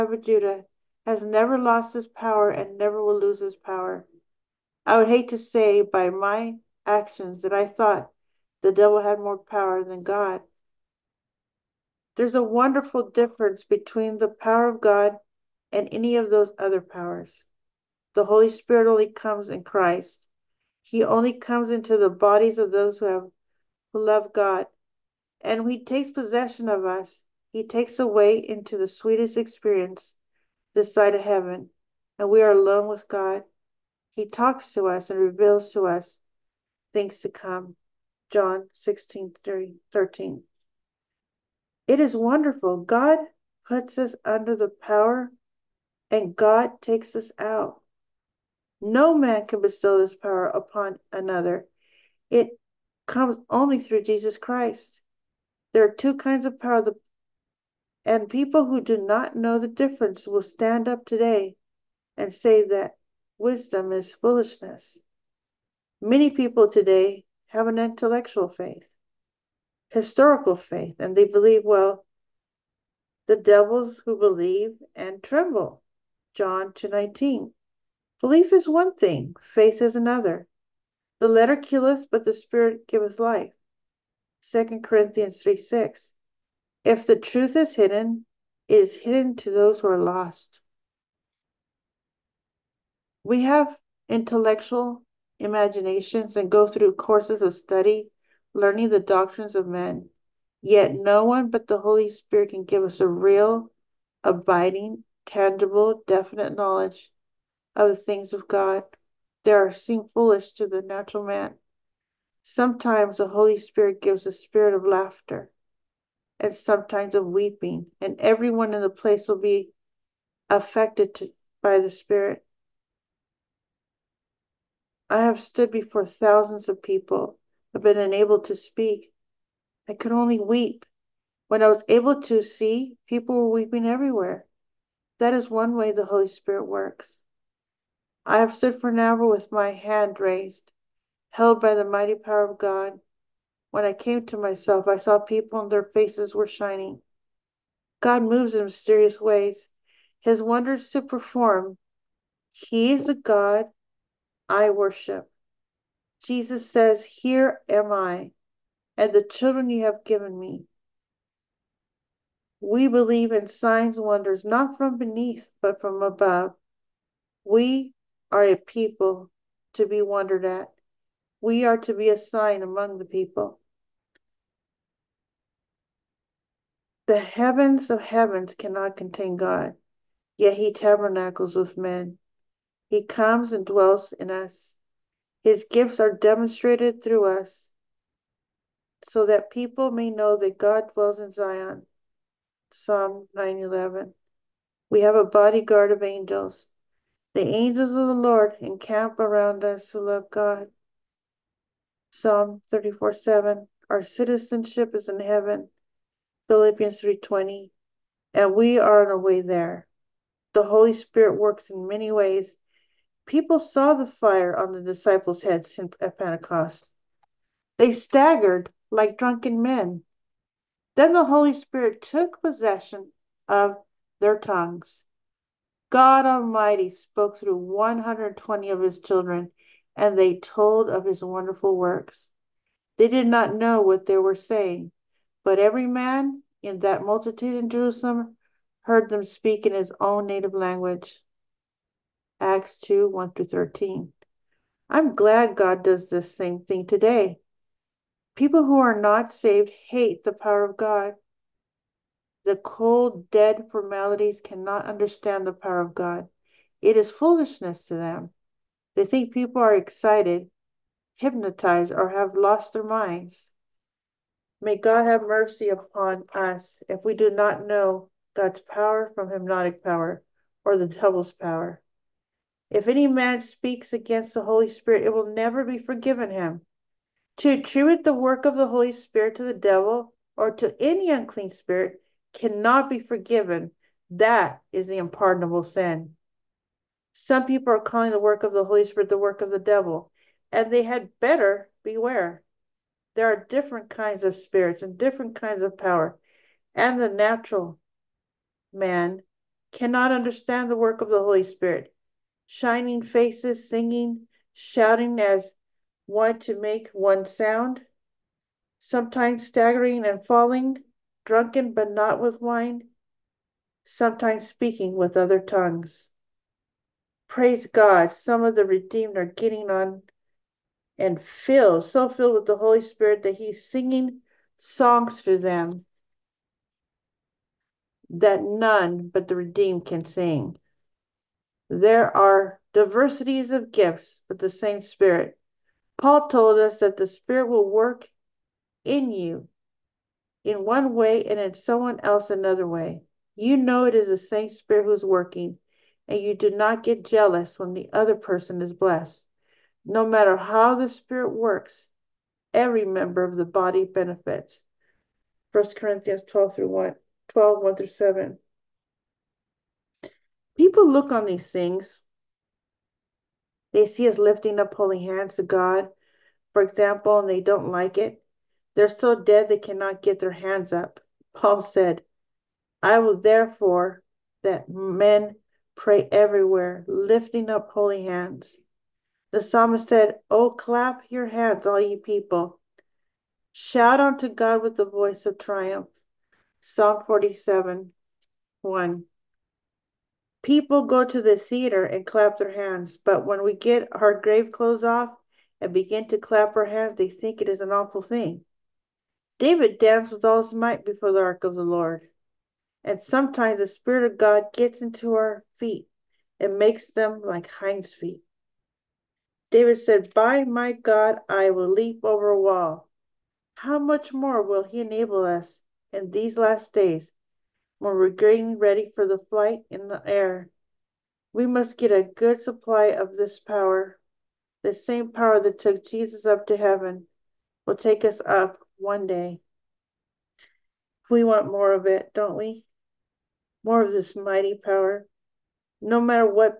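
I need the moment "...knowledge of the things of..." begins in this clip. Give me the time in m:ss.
1:46.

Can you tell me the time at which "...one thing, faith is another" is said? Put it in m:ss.
1:18.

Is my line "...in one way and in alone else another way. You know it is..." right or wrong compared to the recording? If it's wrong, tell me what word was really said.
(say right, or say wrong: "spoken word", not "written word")
wrong: "someone", not "alone".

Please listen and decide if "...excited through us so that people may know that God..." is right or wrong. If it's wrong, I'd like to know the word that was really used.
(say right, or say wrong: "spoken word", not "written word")
wrong: "demonstrated", not "excited".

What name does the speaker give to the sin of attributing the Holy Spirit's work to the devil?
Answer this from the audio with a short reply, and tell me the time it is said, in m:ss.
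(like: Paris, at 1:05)
The unpardonable sin, at 4:44.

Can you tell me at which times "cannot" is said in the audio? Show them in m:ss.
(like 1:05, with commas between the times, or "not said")
2:58, 4:14, 4:42, 4:59, 6:09.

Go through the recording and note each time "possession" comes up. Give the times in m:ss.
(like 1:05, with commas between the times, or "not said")
0:26, 3:42.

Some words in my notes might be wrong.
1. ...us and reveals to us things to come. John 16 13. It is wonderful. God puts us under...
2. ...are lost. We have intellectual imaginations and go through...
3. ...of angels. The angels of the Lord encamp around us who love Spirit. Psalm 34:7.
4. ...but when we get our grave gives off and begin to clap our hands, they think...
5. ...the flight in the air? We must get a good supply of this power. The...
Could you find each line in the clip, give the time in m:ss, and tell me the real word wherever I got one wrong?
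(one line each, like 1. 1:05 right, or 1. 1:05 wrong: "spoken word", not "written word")
1. 0:34 right
2. 1:29 right
3. 3:15 wrong: "God", not "Spirit"
4. 6:32 wrong: "clothes", not "gives"
5. 6:59 right.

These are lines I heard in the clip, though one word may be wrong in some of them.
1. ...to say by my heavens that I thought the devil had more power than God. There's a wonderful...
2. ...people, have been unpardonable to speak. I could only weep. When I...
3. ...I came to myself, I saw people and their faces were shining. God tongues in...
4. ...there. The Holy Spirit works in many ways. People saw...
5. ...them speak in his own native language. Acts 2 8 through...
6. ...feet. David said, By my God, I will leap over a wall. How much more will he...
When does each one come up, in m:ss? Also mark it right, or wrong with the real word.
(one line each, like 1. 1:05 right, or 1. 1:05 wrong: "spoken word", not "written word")
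1. 0:05 wrong: "actions", not "heavens"
2. 2:06 wrong: "unable", not "unpardonable"
3. 2:23 wrong: "moves", not "tongues"
4. 3:29 right
5. 3:59 wrong: "1", not "8"
6. 6:47 right.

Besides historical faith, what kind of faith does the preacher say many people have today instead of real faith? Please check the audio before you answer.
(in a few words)
Intellectual faith.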